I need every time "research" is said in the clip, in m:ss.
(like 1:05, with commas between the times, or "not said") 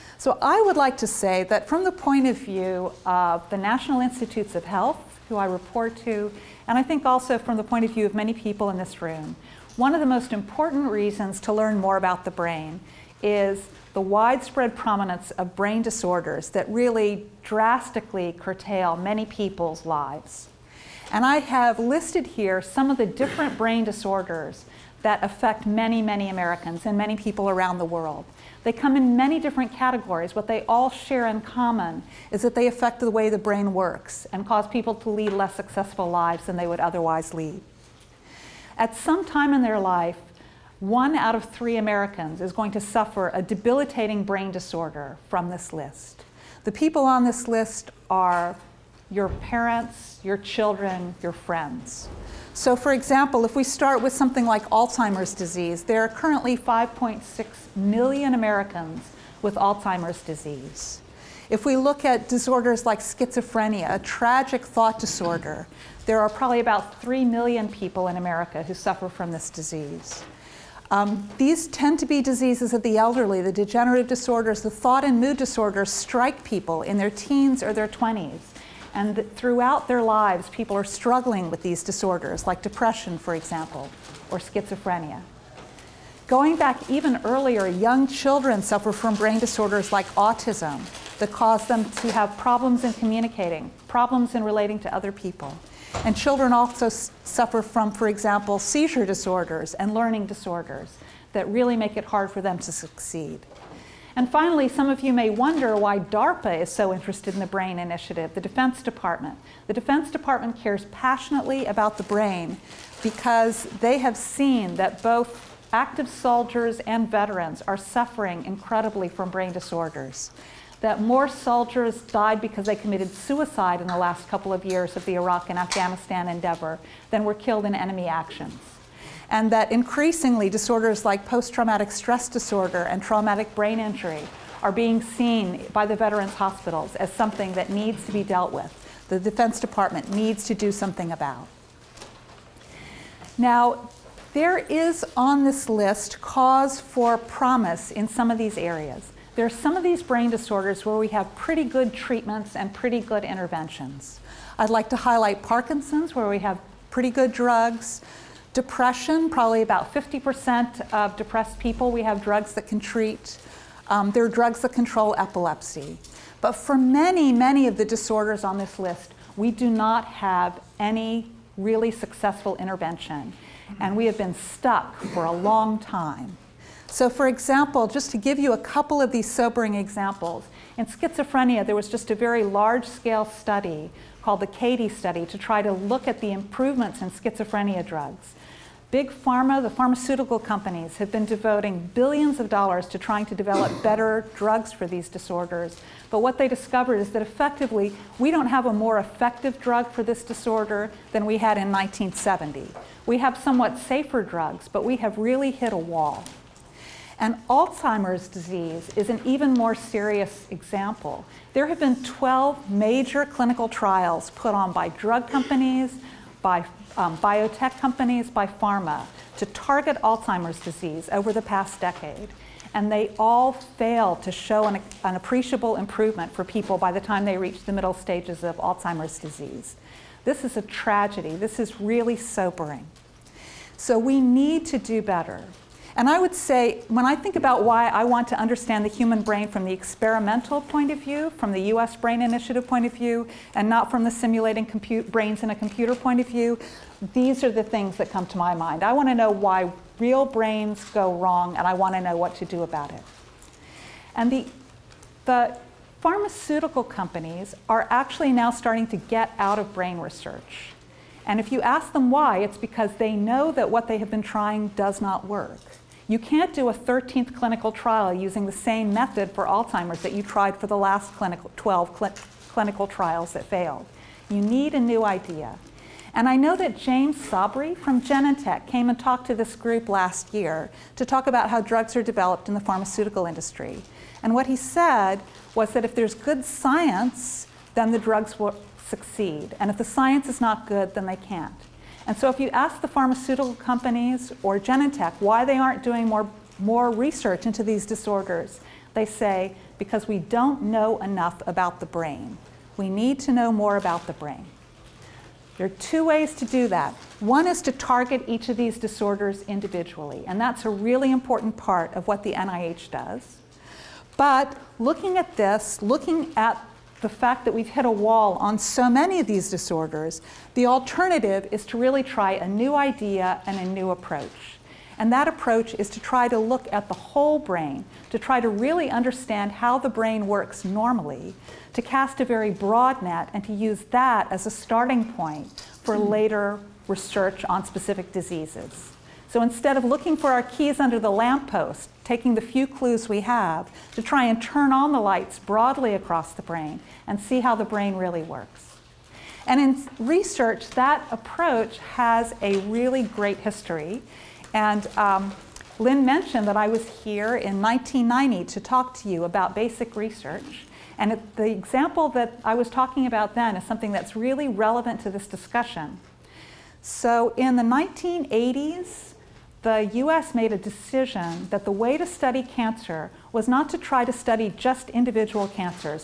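4:19, 4:56, 5:36, 5:49, 5:59.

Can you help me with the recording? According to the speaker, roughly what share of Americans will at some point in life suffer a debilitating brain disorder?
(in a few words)
1 out of 3.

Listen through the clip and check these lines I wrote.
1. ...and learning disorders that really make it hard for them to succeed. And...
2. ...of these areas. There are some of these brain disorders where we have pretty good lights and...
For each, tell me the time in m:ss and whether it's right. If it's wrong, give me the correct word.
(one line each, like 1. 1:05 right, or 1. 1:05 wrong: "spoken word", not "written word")
1. 1:39 right
2. 2:28 wrong: "treatments", not "lights".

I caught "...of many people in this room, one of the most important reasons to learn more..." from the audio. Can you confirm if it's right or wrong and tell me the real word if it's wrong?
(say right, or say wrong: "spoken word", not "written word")
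right.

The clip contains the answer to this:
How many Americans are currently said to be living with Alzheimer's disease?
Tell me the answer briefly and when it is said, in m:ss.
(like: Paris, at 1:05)
5.6 million, at 0:56.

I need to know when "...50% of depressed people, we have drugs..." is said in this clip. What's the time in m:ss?
2:39.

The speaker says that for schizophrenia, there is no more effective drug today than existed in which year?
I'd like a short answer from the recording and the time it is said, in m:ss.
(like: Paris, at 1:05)
1970, at 3:21.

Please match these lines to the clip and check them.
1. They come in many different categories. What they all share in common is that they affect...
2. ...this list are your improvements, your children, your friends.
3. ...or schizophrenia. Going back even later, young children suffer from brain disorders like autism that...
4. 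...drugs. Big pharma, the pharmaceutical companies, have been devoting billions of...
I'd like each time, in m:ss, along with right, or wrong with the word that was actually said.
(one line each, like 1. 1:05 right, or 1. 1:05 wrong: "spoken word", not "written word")
1. 0:28 right
2. 0:47 wrong: "parents", not "improvements"
3. 1:24 wrong: "earlier", not "later"
4. 3:07 right.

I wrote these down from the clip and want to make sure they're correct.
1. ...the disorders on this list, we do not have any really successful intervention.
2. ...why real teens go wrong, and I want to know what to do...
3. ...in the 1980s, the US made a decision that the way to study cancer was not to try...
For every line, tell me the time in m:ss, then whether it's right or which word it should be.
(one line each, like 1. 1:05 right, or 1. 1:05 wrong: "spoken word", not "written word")
1. 2:47 right
2. 4:09 wrong: "brains", not "teens"
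3. 6:07 right.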